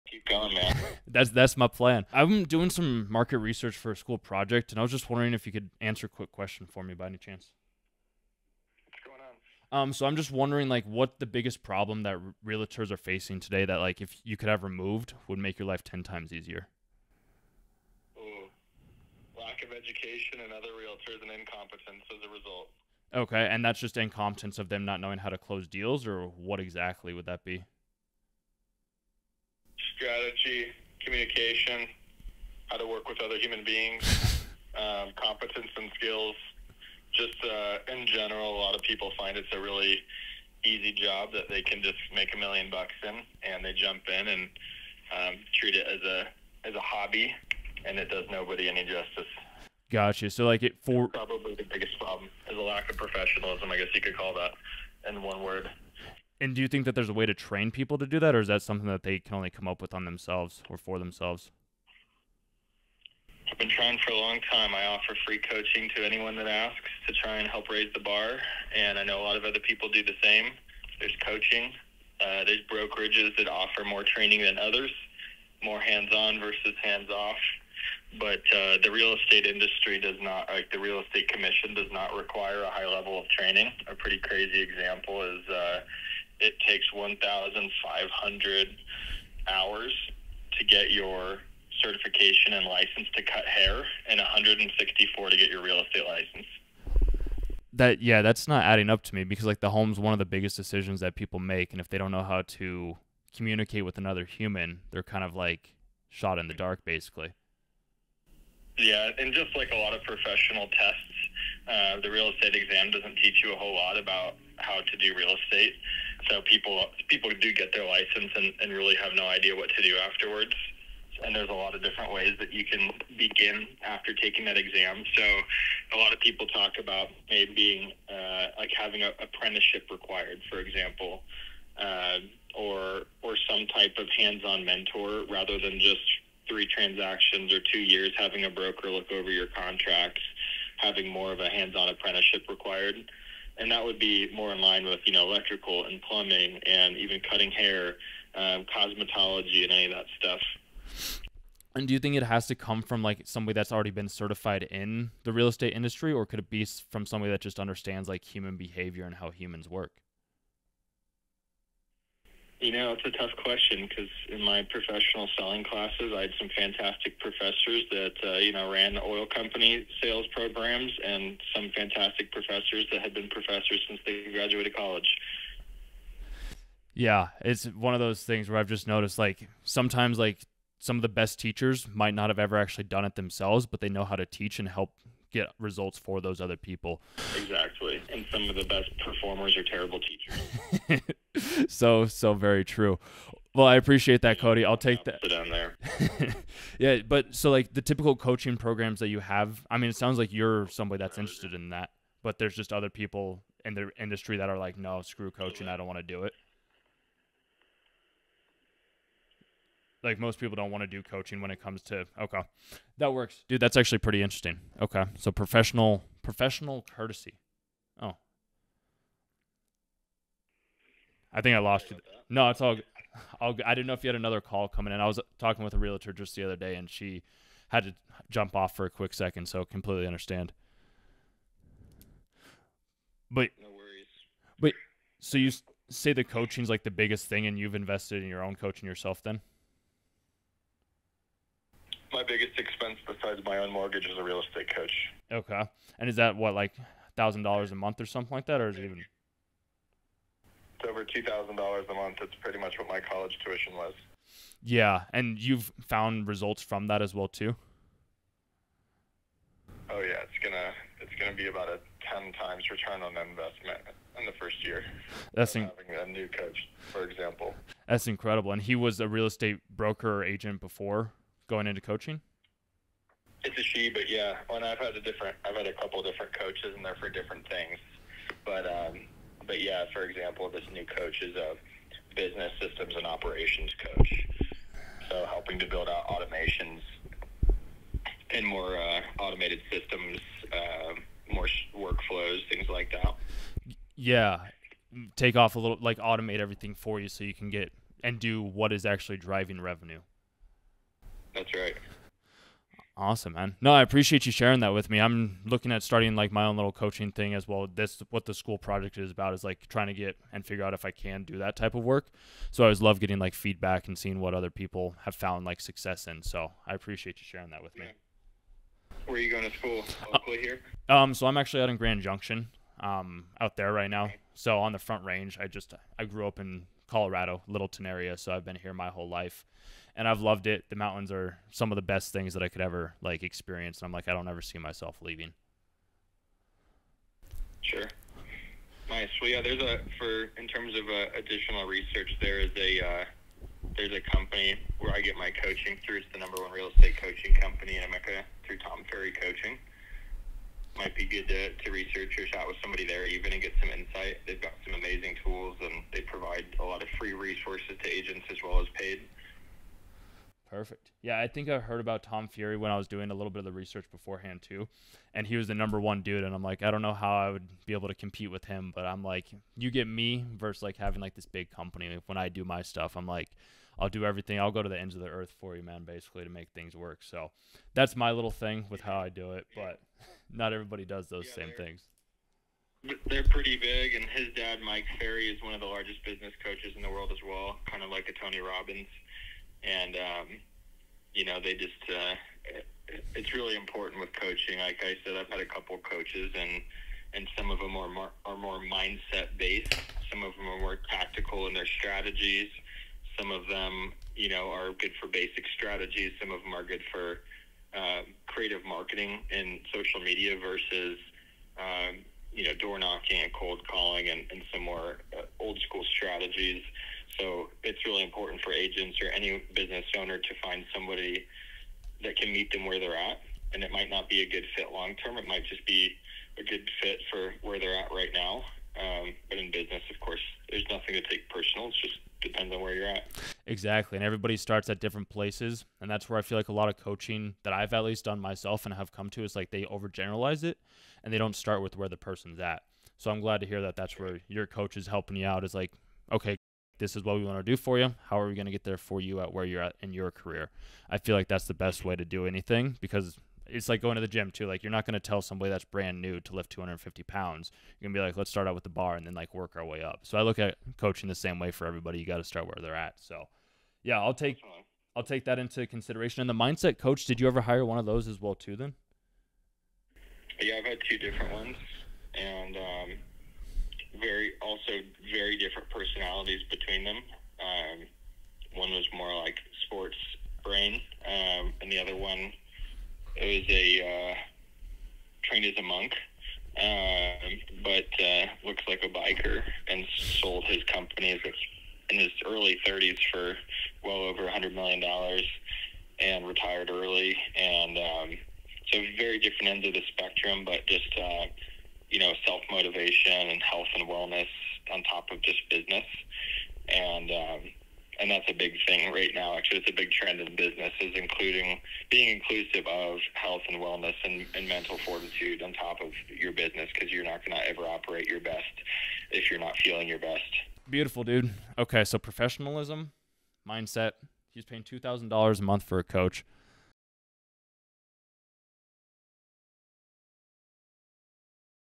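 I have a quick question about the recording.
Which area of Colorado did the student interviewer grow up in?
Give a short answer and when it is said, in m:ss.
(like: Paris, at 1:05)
Littleton, at 5:27.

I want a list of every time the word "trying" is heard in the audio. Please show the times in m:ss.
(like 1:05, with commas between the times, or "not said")
1:03, 5:09.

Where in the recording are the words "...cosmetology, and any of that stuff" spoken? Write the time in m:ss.
2:28.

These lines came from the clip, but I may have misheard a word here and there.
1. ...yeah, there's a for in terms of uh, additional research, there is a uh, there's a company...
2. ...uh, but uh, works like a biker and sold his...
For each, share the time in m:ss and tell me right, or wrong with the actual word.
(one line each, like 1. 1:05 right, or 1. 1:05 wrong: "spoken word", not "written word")
1. 5:39 right
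2. 8:06 wrong: "looks", not "works".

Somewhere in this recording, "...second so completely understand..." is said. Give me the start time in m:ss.
3:49.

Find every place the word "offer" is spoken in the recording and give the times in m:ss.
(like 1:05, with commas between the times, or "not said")
1:04, 1:13.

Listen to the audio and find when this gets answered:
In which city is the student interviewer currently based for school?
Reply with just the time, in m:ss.
5:21.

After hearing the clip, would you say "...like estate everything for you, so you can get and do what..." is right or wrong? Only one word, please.
wrong.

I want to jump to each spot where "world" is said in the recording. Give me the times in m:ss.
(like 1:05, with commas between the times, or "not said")
6:26.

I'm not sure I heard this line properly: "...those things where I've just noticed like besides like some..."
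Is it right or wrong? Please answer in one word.
wrong.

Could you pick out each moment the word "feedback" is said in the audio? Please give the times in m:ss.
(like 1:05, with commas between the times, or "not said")
5:13.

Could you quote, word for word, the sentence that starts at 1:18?
But uh, the real estate industry does not, like the real estate commission, does not require a high level of training.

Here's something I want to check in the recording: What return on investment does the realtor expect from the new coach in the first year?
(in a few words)
10 times.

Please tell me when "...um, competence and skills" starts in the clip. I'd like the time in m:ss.
0:34.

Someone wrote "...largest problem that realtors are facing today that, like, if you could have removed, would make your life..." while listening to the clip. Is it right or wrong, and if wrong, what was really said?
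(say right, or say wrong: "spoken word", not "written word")
wrong: "biggest", not "largest".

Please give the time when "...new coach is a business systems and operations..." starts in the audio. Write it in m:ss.
4:40.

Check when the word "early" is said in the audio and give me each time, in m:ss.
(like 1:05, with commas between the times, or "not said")
8:12, 8:16.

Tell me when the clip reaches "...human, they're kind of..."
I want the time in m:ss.
1:44.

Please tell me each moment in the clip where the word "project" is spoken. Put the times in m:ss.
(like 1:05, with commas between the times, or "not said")
0:04, 5:08.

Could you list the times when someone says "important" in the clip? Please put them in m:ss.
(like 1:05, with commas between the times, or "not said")
6:33, 6:58.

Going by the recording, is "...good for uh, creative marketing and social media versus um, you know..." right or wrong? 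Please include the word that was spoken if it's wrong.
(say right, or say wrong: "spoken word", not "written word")
right.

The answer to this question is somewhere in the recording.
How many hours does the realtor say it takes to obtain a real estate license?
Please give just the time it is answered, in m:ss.
1:34.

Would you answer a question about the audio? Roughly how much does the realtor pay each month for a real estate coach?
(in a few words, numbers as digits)
Over $2,000.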